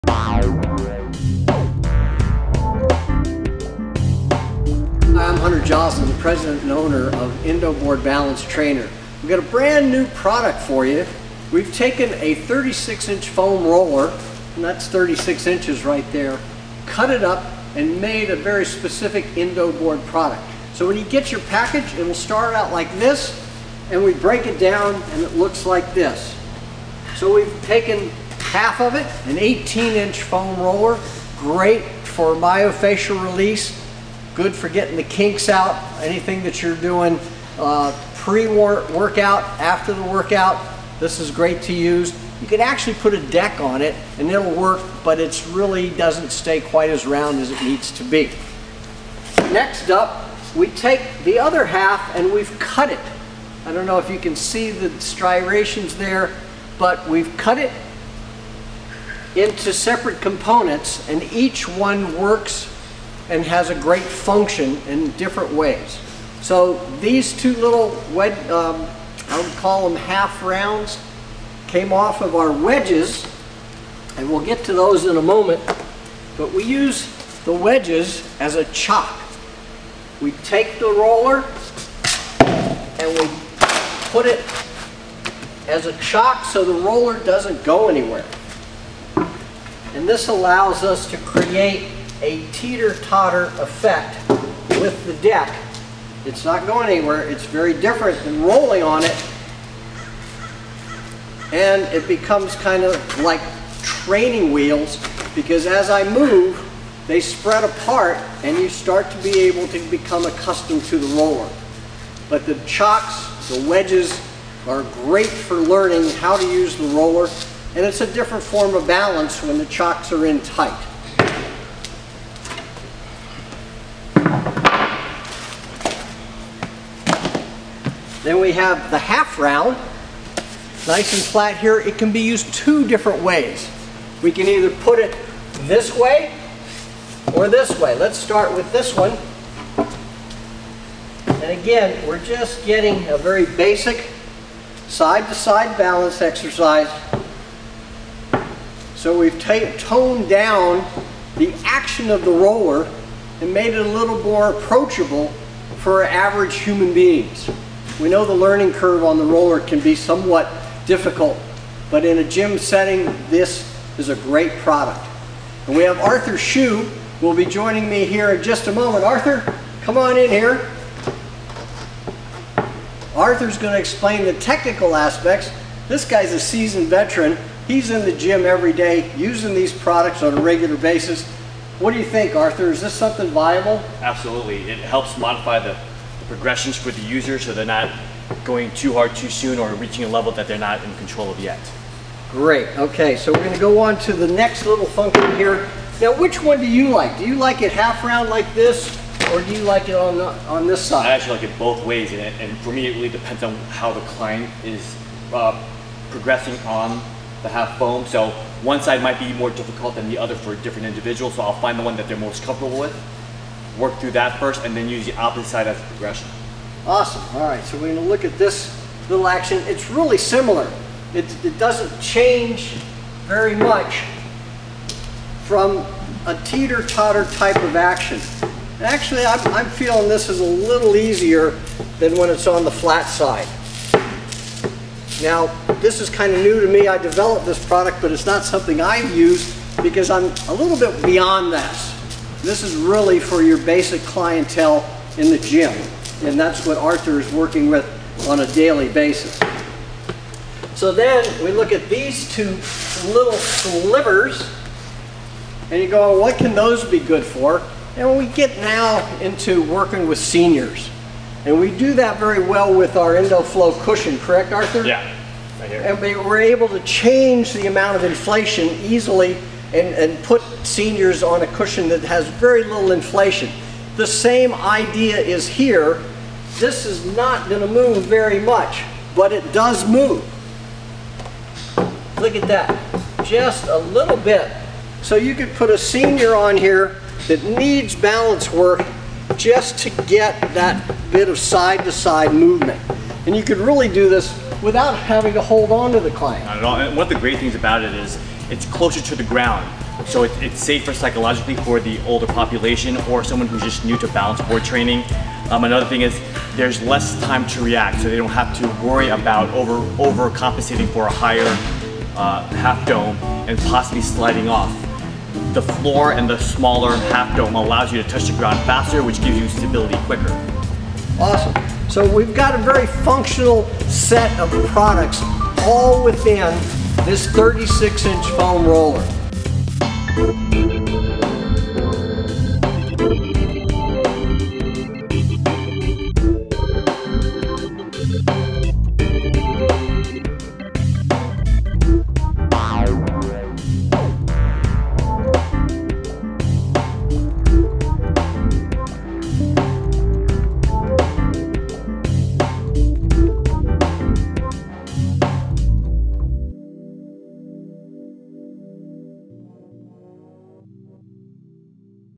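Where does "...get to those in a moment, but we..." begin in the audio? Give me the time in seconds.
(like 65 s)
74 s.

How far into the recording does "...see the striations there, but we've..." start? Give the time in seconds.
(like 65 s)
54 s.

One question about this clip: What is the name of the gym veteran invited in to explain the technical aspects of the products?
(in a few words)
Arthur Hsu.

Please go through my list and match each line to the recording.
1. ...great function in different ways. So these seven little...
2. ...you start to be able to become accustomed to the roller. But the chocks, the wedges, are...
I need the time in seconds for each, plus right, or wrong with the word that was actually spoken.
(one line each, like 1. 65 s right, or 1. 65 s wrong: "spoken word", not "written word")
1. 63 s wrong: "two", not "seven"
2. 108 s right.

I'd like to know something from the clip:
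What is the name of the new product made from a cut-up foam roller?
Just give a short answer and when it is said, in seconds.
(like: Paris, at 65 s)
Indoboard Balance Trainer, at 7 s.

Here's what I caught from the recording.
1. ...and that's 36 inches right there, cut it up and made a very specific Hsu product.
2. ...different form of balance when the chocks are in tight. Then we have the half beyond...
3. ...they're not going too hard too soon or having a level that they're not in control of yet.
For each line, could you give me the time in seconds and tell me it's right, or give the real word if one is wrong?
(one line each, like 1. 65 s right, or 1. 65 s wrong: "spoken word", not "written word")
1. 14 s wrong: "Indoboard", not "Hsu"
2. 118 s wrong: "round", not "beyond"
3. 187 s wrong: "reaching", not "having".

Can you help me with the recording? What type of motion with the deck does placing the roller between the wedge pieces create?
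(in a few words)
teeter-totter effect.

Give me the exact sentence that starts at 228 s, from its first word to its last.
And actually, I'm, I'm feeling this is a little easier than when it's on the flat side.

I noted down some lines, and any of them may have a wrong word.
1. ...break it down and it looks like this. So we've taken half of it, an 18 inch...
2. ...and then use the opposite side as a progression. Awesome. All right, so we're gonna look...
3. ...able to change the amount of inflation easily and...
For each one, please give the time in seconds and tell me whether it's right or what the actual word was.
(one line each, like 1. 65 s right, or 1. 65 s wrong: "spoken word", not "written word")
1. 24 s right
2. 214 s right
3. 266 s right.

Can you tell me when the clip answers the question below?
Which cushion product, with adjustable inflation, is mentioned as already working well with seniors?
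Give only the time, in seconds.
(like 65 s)
263 s.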